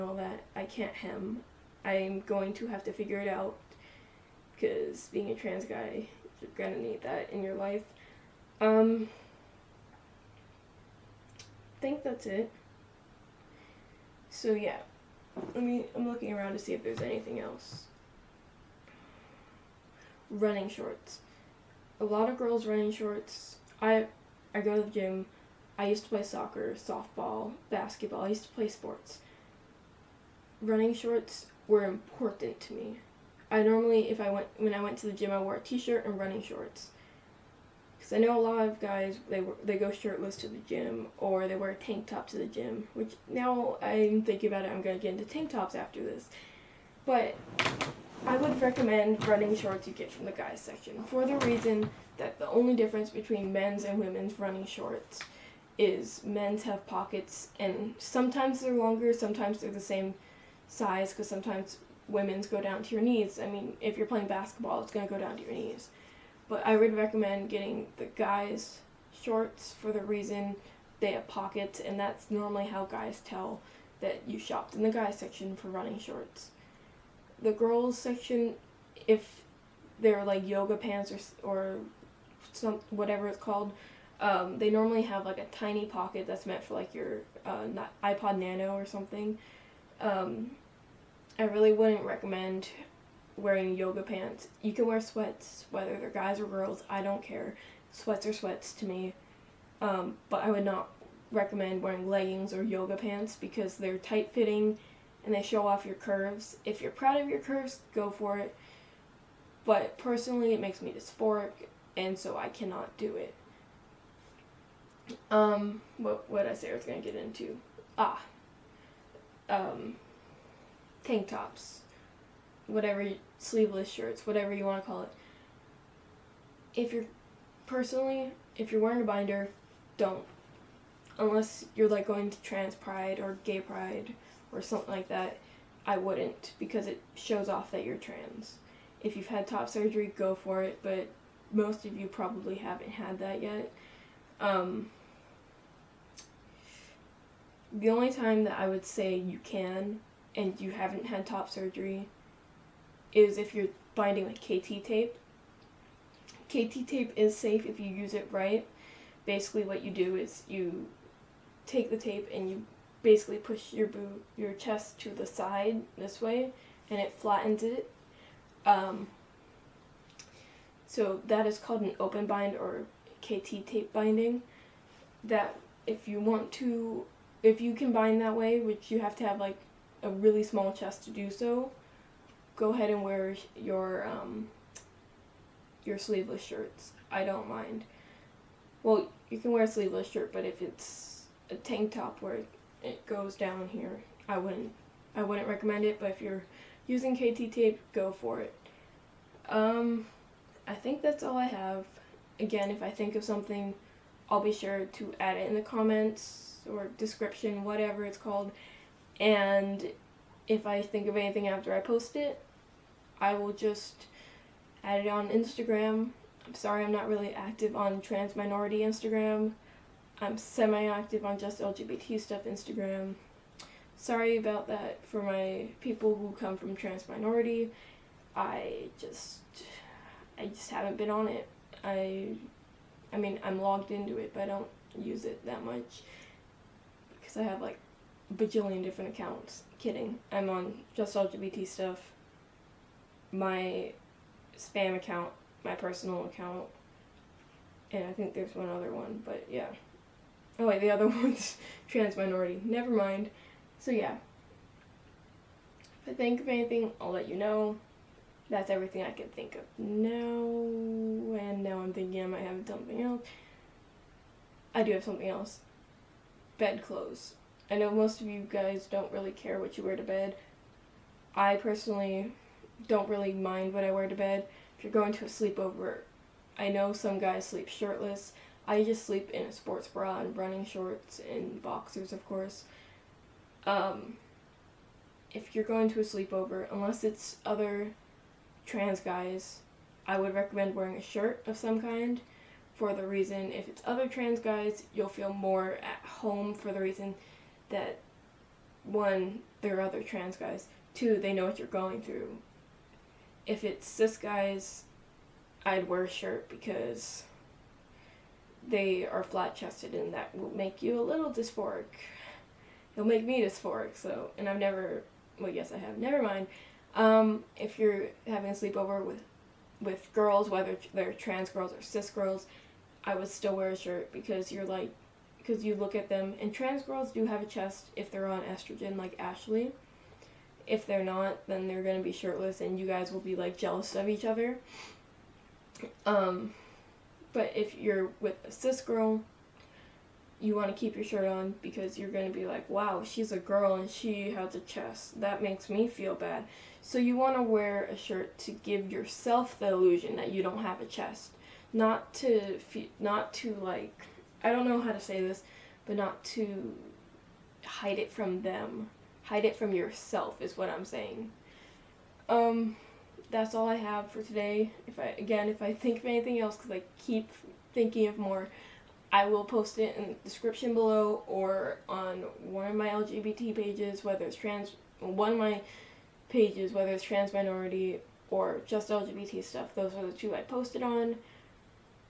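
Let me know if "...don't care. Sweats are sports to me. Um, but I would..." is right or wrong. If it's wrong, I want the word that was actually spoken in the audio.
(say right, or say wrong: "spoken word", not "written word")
wrong: "sweats", not "sports".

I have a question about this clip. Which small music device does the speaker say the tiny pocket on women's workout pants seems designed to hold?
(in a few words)
iPod Nano.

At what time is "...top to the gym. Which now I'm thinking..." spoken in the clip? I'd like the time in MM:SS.
00:42.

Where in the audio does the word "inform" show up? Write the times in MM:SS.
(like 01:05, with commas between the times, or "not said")
not said.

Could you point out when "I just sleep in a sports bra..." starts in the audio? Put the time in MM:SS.
04:38.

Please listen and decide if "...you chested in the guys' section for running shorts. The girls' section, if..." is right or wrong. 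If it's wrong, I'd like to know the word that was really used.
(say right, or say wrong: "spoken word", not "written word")
wrong: "shopped", not "chested".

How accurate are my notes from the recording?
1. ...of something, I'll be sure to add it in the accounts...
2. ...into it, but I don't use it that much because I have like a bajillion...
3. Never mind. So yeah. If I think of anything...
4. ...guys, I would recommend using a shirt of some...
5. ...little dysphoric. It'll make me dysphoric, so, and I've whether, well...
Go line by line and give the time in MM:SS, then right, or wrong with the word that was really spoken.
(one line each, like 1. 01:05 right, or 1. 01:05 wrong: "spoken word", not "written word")
1. 03:23 wrong: "comments", not "accounts"
2. 03:53 right
3. 04:12 right
4. 04:48 wrong: "wearing", not "using"
5. 05:11 wrong: "never", not "whether".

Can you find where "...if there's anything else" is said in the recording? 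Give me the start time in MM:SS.
00:16.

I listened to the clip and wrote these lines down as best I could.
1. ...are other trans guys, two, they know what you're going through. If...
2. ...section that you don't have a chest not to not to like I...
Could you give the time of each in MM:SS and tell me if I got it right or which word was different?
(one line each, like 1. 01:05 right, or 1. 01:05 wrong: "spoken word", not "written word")
1. 04:59 right
2. 05:49 wrong: "illusion", not "section".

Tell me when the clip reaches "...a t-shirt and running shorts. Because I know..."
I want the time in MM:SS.
00:35.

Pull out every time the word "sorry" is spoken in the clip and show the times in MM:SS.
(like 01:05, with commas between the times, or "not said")
03:36, 03:43.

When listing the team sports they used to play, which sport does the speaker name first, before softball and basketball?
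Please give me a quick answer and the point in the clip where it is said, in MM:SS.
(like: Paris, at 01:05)
soccer, at 00:26.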